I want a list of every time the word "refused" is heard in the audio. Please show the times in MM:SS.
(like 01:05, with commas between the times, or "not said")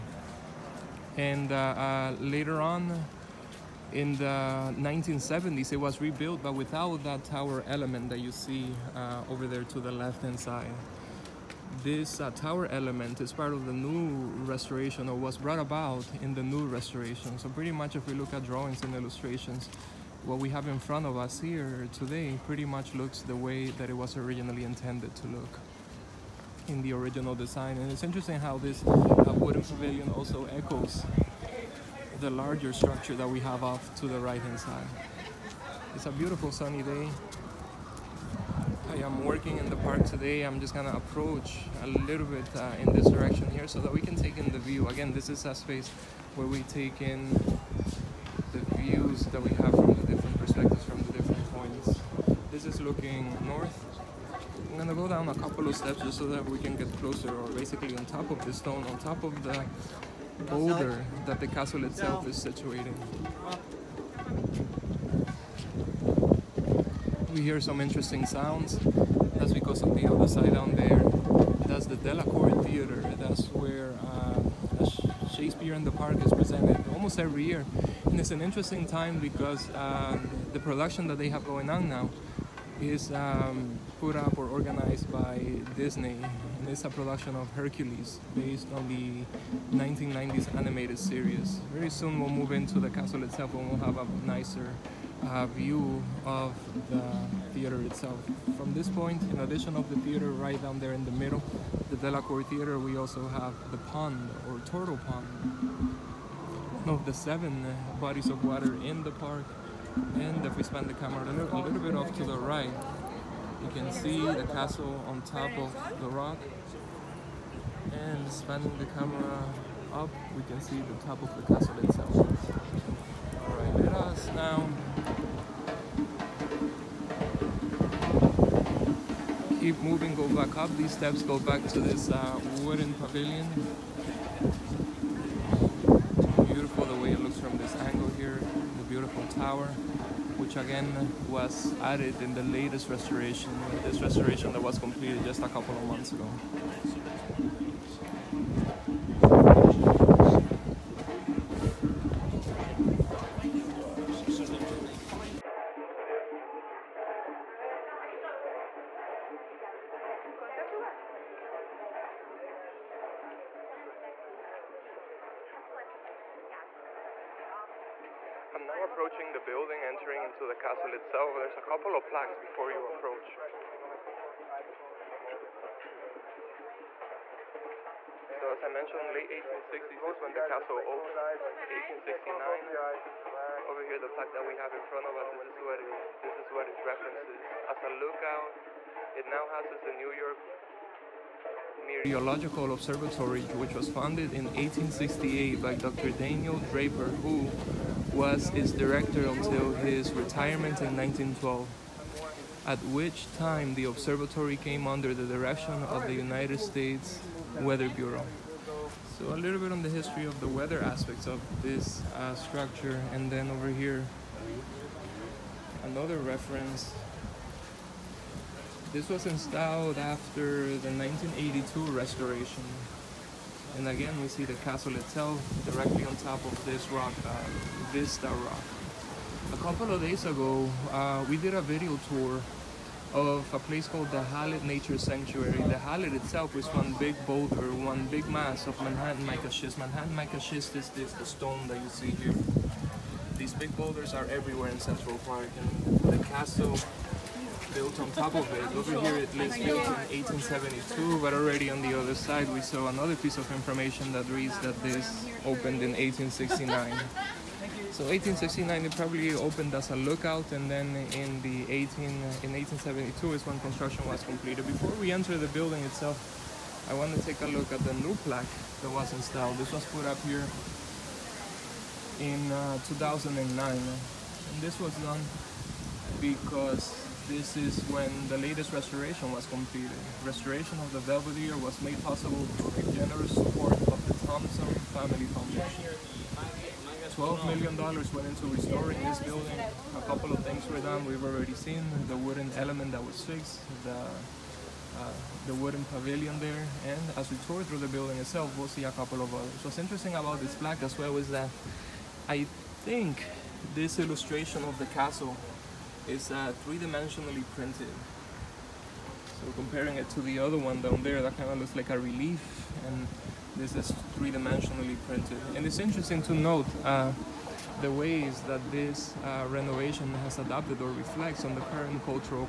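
not said.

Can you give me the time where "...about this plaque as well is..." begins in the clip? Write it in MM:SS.
05:00.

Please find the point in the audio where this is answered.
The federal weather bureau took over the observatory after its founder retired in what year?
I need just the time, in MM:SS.
03:20.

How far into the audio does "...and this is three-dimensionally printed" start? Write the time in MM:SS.
05:12.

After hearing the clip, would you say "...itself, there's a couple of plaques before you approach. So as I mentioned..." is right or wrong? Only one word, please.
right.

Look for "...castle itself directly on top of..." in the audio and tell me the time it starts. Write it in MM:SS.
03:44.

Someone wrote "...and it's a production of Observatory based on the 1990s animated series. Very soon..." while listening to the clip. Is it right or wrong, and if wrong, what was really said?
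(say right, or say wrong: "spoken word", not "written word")
wrong: "Hercules", not "Observatory".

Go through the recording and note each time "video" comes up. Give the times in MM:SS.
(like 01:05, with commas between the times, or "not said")
03:51.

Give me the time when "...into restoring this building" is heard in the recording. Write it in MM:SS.
04:48.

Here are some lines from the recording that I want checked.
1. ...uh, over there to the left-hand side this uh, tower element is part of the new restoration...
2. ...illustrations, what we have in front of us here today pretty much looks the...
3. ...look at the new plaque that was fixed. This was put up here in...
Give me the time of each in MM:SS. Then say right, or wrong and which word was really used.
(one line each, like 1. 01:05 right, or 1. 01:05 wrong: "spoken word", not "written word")
1. 00:08 right
2. 00:18 right
3. 04:27 wrong: "installed", not "fixed".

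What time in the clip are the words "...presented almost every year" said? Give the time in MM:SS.
01:16.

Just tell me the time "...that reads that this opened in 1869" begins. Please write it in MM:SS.
04:14.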